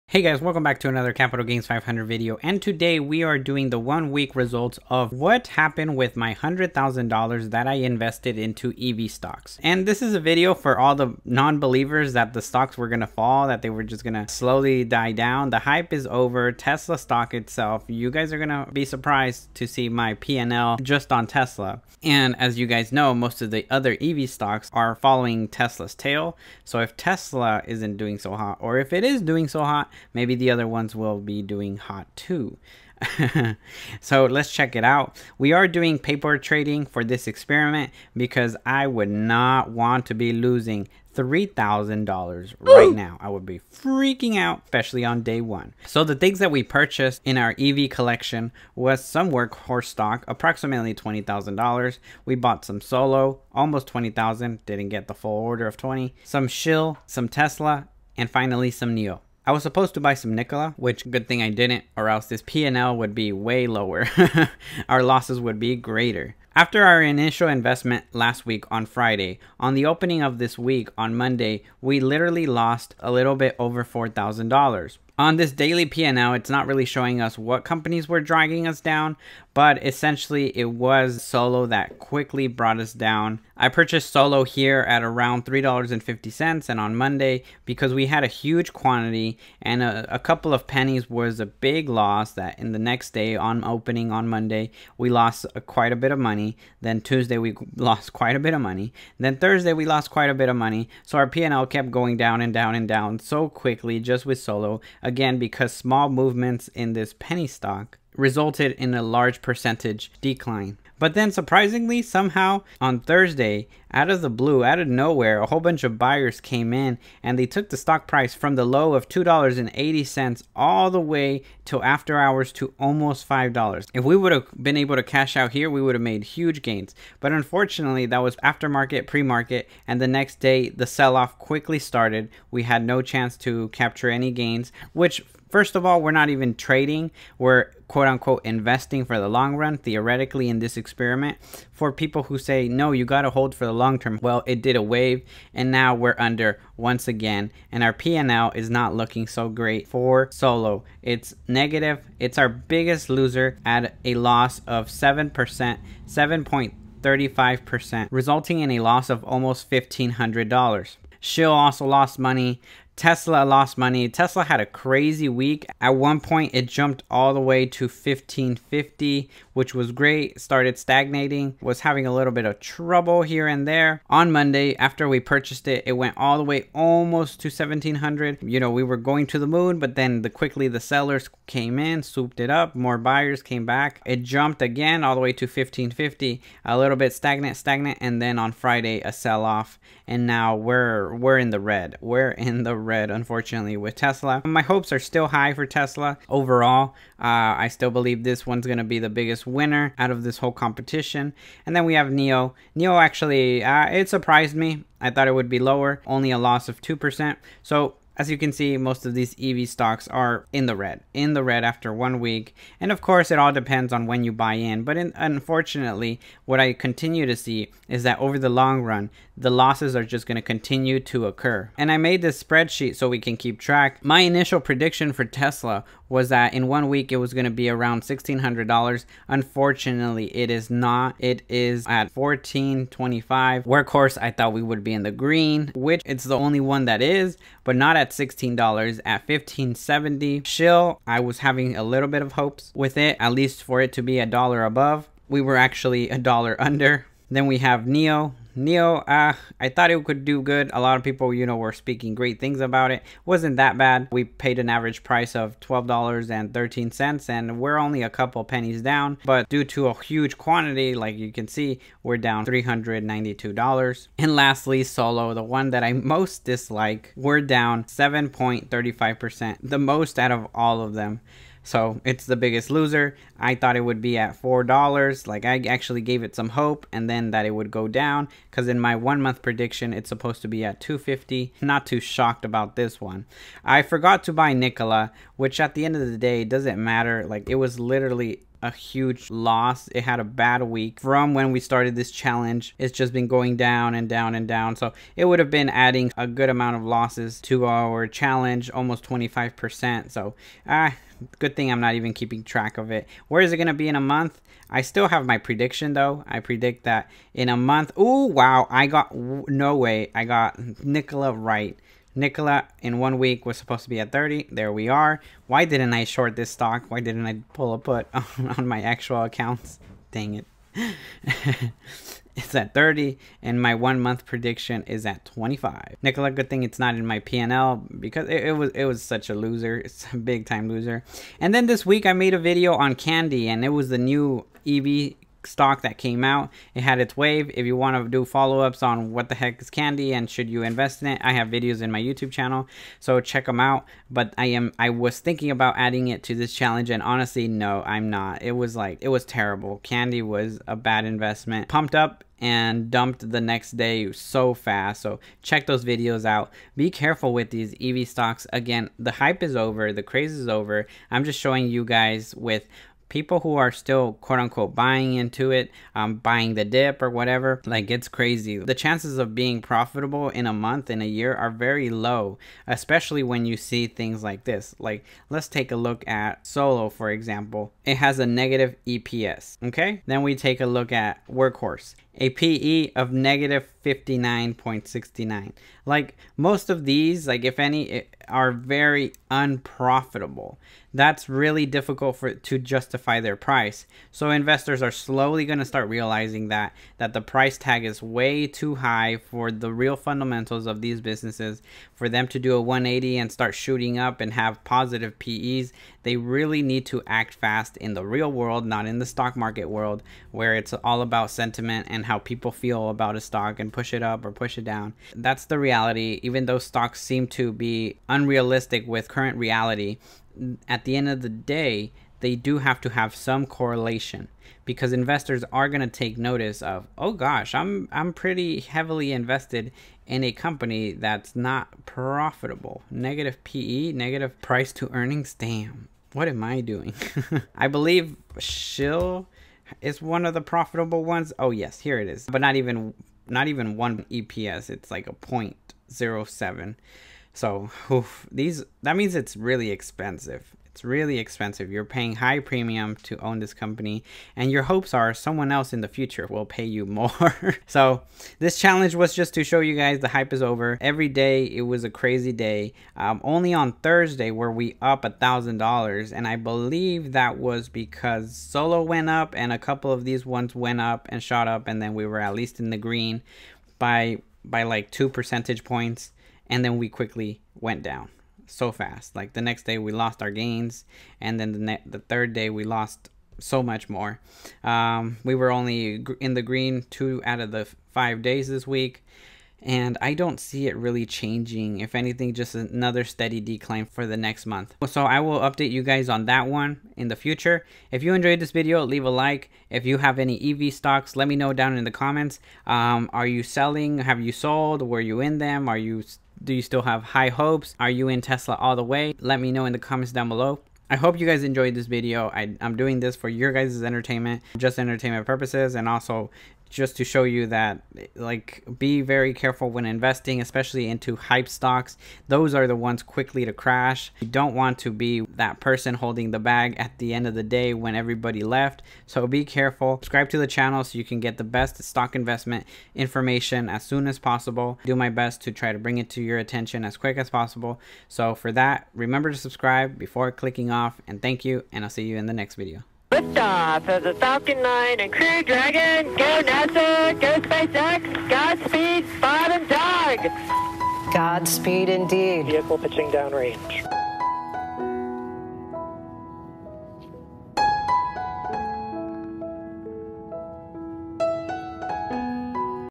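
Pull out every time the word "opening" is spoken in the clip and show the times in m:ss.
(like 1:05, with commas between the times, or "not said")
1:09, 1:33.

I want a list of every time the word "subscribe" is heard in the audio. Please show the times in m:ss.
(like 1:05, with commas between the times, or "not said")
8:49, 8:59.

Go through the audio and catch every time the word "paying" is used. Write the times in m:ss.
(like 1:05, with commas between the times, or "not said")
7:31.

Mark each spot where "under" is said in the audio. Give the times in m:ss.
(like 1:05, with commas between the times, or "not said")
2:26, 4:06.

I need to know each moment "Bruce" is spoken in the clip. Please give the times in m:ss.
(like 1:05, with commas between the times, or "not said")
not said.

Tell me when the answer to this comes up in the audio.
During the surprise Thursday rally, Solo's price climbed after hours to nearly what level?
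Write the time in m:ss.
2:02.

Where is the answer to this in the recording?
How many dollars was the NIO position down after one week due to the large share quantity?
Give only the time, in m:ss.
4:22.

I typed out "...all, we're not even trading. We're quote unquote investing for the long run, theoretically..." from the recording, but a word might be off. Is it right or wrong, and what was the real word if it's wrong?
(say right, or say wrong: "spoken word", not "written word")
right.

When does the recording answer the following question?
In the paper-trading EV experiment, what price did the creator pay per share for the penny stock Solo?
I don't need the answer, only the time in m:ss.
1:25.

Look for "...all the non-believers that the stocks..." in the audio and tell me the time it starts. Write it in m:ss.
0:10.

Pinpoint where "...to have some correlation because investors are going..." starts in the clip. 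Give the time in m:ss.
7:02.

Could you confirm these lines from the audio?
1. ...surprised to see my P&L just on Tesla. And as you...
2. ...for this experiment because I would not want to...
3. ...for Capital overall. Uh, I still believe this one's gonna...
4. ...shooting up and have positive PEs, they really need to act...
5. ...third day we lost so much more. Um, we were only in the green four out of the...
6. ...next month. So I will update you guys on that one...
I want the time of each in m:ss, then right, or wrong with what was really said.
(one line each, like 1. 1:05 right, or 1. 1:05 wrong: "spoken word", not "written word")
1. 0:18 right
2. 0:36 right
3. 3:15 wrong: "Tesla", not "Capital"
4. 6:43 right
5. 8:01 wrong: "two", not "four"
6. 8:14 right.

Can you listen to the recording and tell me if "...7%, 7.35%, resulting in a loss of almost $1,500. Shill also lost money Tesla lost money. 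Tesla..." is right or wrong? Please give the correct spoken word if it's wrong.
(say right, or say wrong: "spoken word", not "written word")
right.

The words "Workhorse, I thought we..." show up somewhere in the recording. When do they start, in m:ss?
3:53.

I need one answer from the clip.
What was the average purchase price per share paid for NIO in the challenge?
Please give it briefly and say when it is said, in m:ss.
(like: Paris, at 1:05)
$12.13, at 4:15.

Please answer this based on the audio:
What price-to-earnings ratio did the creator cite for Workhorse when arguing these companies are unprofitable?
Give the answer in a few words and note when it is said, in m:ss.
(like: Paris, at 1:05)
-59.69, at 6:23.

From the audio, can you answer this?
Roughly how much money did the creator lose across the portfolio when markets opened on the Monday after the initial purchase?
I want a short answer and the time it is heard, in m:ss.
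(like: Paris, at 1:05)
a little bit over $4,000, at 1:12.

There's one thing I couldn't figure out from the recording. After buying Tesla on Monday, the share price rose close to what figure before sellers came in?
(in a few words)
1700.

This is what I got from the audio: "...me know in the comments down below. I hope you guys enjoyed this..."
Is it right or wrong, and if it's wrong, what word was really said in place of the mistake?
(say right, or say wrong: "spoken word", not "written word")
right.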